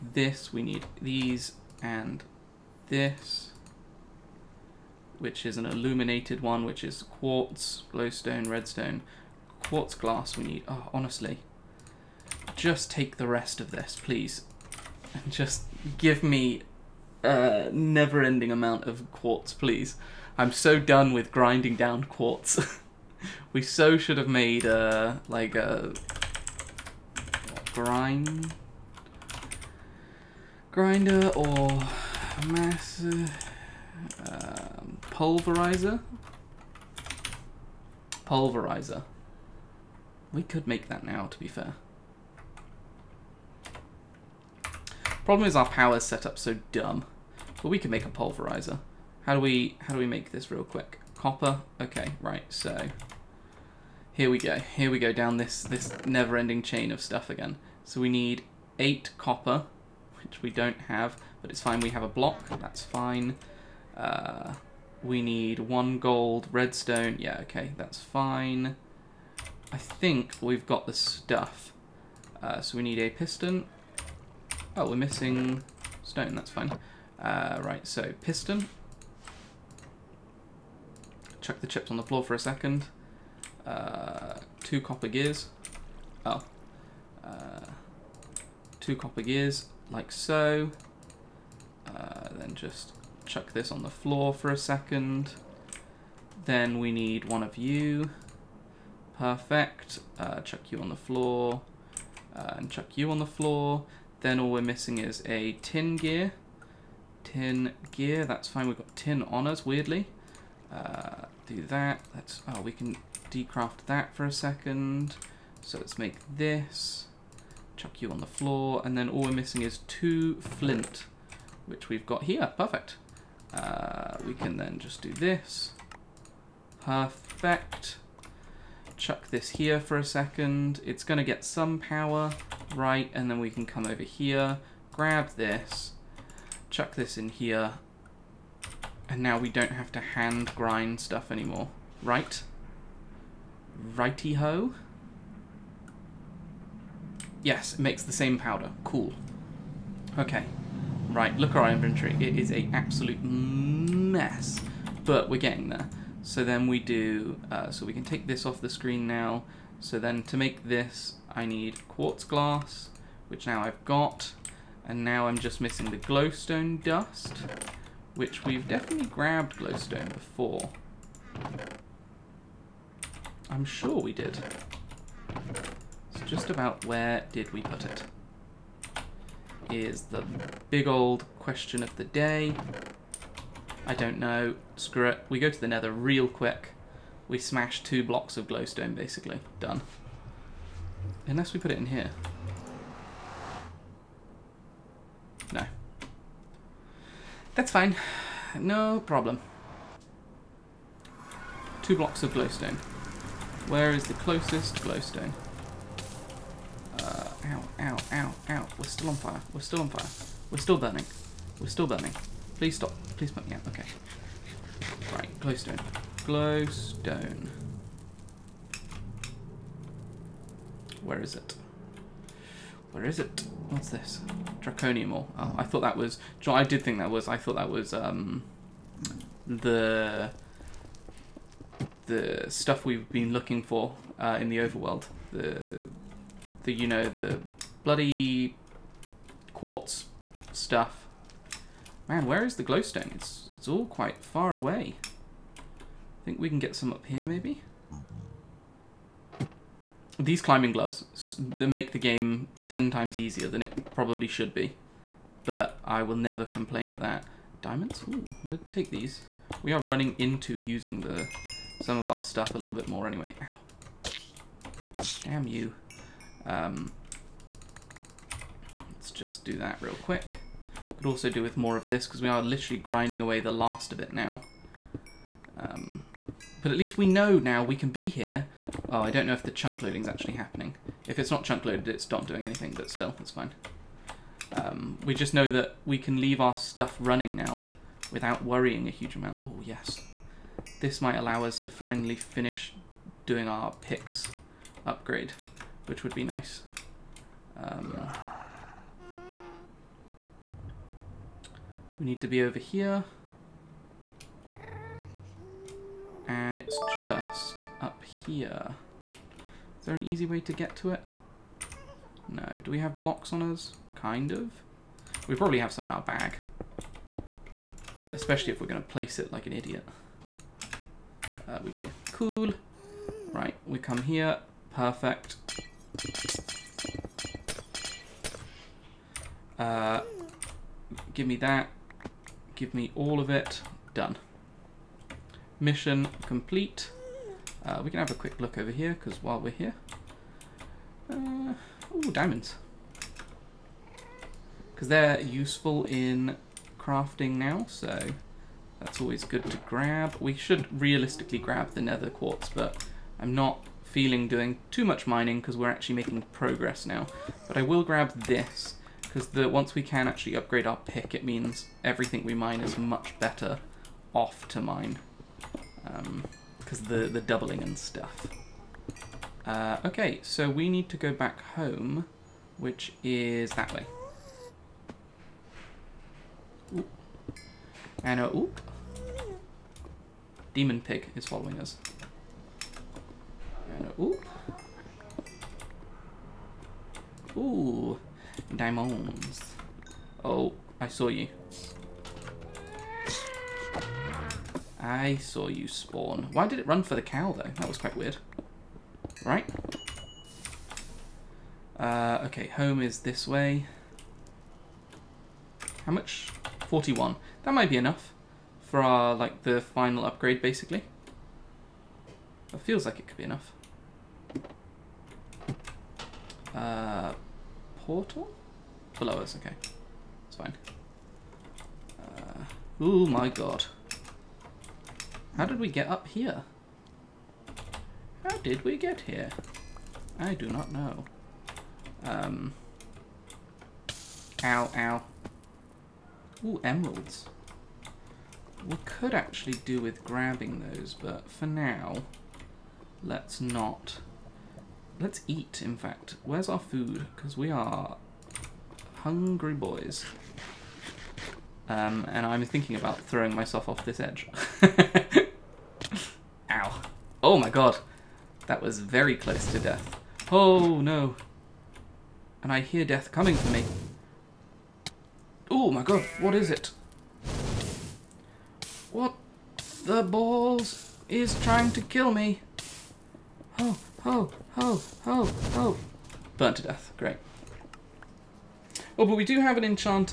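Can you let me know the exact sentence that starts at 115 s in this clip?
So let's make this chuck you on the floor, and then all we're missing is two flint, which we've got here.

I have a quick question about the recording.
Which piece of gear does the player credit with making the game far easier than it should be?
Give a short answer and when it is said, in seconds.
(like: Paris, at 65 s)
Climbing gloves, at 250 s.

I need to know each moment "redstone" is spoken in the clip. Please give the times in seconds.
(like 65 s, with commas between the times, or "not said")
8 s, 66 s.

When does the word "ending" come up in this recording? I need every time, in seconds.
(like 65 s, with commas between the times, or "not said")
17 s, 56 s.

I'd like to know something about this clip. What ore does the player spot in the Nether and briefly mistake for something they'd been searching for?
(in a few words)
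Draconium ore.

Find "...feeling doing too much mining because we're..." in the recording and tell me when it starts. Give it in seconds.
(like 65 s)
353 s.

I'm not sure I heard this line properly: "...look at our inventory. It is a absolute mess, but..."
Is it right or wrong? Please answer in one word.
right.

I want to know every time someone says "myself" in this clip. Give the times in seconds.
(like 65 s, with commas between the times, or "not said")
453 s.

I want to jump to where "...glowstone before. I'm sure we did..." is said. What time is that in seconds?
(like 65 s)
169 s.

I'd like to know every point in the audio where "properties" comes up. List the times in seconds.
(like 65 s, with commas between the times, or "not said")
not said.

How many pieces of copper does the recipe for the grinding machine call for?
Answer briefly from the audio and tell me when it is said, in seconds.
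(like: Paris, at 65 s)
8, at 58 s.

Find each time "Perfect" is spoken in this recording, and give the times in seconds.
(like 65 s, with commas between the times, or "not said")
99 s, 122 s, 126 s, 324 s.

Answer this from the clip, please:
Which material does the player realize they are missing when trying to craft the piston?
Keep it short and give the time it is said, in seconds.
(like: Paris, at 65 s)
Stone, at 76 s.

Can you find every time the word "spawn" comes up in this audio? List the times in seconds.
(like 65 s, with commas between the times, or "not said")
395 s.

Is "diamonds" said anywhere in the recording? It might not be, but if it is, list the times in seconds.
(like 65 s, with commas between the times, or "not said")
257 s, 342 s, 388 s.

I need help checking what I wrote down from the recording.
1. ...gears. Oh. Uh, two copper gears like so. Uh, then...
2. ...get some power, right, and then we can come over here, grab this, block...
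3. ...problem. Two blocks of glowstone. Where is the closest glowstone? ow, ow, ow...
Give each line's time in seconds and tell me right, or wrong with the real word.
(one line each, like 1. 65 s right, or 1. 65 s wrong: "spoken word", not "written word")
1. 85 s right
2. 131 s wrong: "chuck", not "block"
3. 199 s right.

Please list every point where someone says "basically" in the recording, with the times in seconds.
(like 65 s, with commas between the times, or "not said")
188 s, 410 s.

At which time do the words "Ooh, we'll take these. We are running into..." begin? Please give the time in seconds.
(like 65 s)
258 s.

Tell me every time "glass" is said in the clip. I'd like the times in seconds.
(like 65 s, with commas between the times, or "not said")
9 s, 162 s.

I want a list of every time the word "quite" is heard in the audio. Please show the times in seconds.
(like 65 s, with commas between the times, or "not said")
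243 s, 397 s.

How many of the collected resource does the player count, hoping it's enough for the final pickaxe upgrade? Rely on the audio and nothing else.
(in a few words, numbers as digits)
41.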